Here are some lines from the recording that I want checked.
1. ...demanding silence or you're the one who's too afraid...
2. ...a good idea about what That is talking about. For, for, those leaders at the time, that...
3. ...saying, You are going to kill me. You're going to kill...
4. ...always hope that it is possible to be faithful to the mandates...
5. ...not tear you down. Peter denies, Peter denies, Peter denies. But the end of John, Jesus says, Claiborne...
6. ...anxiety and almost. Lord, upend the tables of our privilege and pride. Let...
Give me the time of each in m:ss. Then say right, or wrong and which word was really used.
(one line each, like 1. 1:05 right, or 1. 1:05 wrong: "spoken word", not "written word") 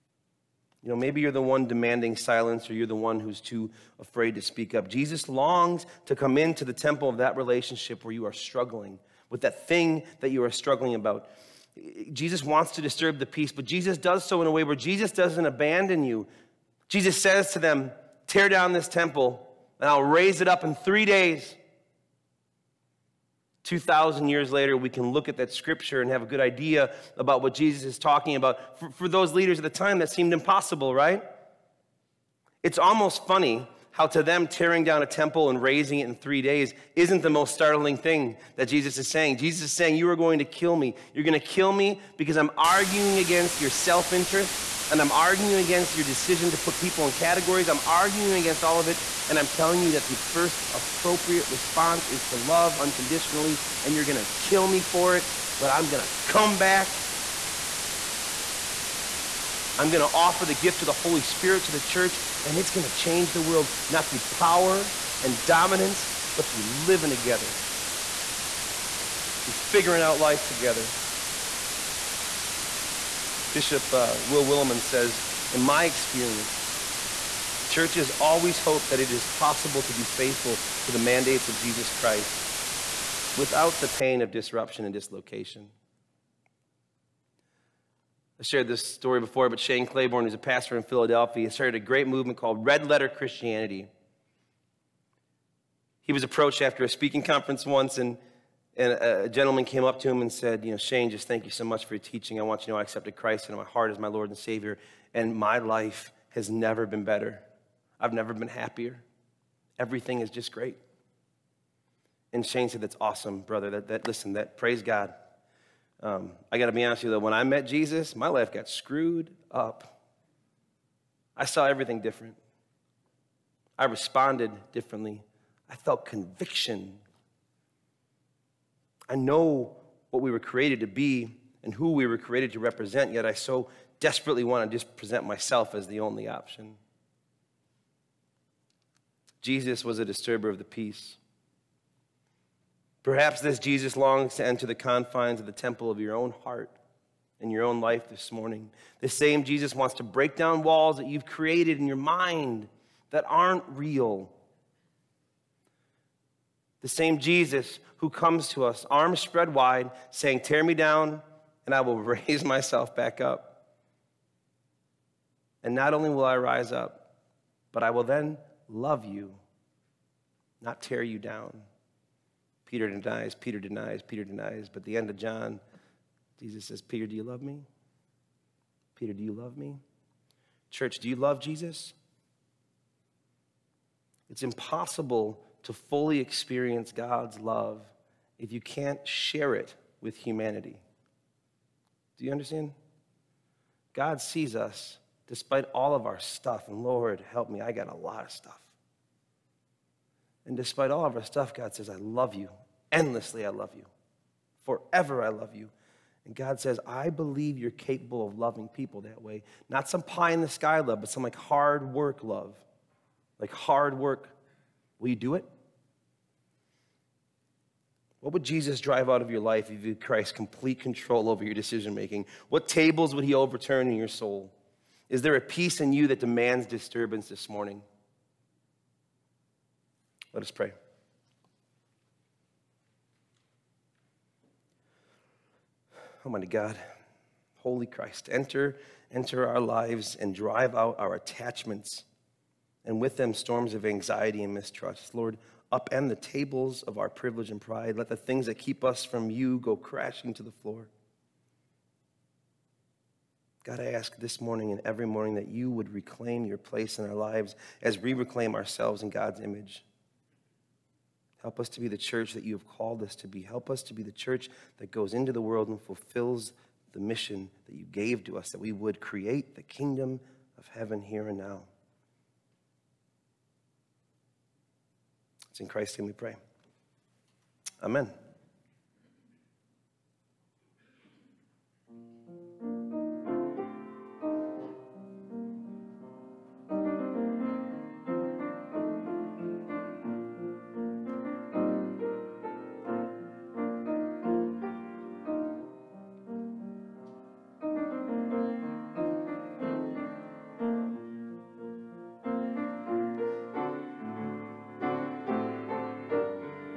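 1. 0:01 right
2. 0:26 wrong: "Jesus", not "That"
3. 0:39 right
4. 1:18 right
5. 2:50 wrong: "Peter", not "Claiborne"
6. 4:03 wrong: "mistrust", not "almost".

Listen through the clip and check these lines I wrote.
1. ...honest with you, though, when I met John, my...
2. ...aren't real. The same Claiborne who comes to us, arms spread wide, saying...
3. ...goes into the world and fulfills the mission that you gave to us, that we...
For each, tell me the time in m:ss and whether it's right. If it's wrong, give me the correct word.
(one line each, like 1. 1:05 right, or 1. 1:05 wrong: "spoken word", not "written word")
1. 1:56 wrong: "Jesus", not "John"
2. 2:33 wrong: "Jesus", not "Claiborne"
3. 4:24 right.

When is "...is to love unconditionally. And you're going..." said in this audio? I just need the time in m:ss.
0:52.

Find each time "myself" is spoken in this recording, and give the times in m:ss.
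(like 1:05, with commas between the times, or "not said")
2:15, 2:42.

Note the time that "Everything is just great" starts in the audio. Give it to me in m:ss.
1:49.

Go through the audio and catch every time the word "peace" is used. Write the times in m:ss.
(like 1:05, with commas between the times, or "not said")
0:13, 2:20, 3:45.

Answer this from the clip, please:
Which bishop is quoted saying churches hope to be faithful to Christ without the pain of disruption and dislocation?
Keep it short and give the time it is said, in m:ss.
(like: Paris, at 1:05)
Will Willimon, at 1:14.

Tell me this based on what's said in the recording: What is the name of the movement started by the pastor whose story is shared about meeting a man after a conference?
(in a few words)
Red Letter Christianity.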